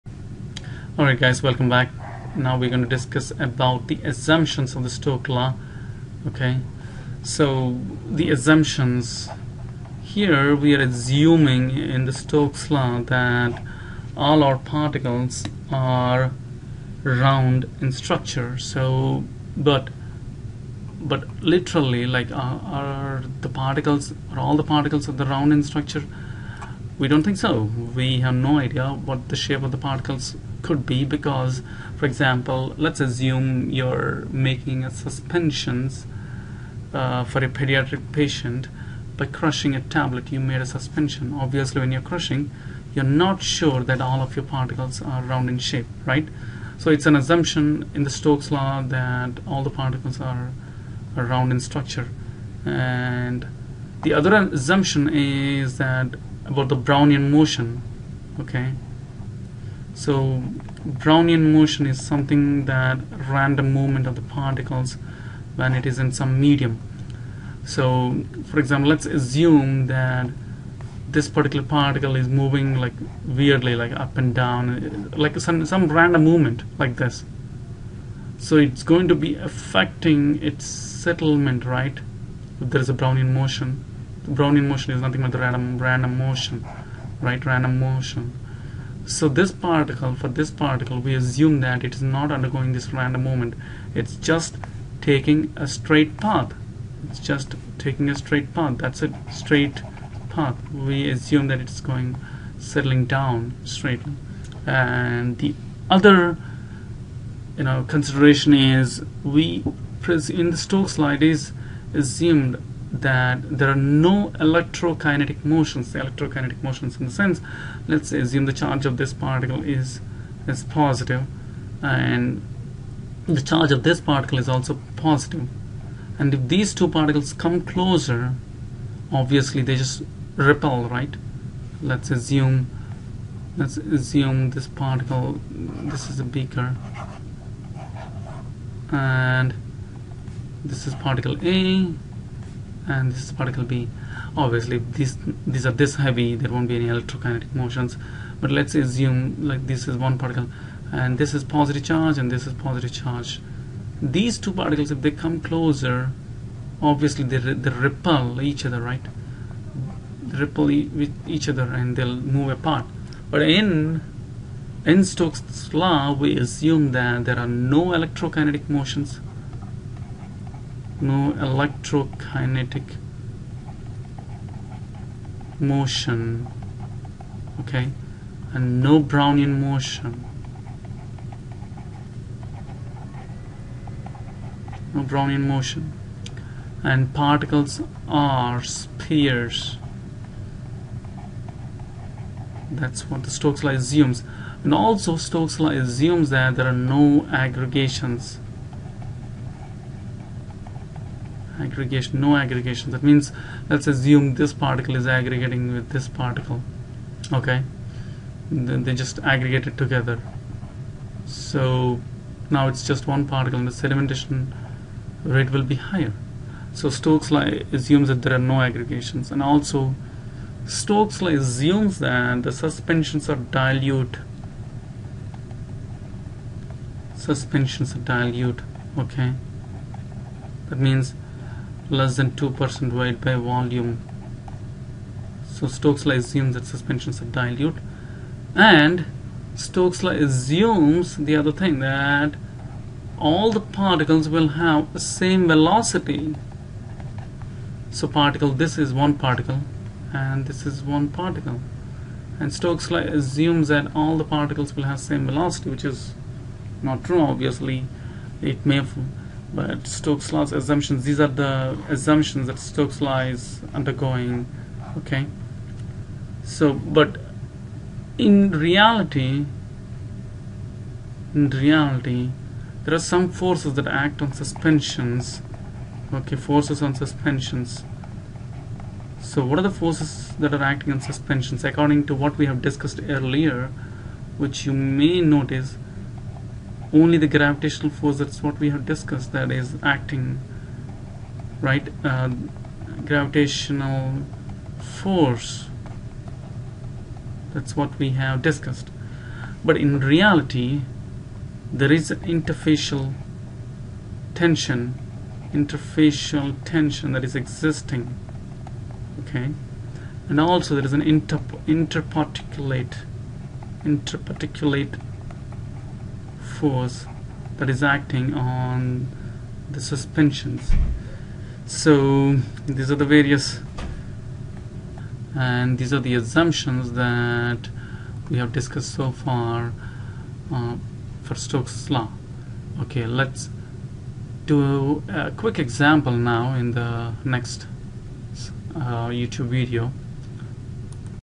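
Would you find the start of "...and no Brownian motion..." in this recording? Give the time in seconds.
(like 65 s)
178 s.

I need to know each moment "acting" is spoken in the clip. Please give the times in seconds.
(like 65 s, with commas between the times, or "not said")
280 s, 289 s, 317 s.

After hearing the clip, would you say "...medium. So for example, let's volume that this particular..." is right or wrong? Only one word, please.
wrong.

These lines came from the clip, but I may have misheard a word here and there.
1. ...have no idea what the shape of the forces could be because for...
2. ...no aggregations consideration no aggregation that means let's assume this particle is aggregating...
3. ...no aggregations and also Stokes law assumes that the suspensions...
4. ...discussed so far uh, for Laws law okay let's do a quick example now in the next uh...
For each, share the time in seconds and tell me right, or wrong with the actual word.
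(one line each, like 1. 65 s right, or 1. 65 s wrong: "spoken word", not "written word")
1. 28 s wrong: "particles", not "forces"
2. 196 s wrong: "aggregation", not "consideration"
3. 218 s right
4. 328 s wrong: "Stokes", not "Laws".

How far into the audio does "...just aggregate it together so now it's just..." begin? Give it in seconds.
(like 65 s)
209 s.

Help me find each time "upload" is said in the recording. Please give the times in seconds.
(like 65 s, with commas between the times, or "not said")
not said.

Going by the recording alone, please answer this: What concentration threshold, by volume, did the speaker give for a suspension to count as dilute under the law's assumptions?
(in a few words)
Less than 2%.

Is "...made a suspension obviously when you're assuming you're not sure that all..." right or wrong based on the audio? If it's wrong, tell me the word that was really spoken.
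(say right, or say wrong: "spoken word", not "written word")
wrong: "crushing", not "assuming".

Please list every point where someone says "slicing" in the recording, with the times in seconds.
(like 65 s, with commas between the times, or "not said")
not said.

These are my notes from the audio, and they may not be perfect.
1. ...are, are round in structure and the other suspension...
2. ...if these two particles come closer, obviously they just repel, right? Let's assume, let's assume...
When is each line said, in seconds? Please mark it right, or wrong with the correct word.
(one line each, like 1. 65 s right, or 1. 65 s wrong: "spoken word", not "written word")
1. 50 s wrong: "assumption", not "suspension"
2. 126 s right.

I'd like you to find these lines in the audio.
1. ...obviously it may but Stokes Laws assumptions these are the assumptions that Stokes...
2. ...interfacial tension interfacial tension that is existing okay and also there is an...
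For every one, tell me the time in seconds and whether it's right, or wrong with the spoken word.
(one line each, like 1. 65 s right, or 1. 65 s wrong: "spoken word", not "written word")
1. 257 s right
2. 302 s right.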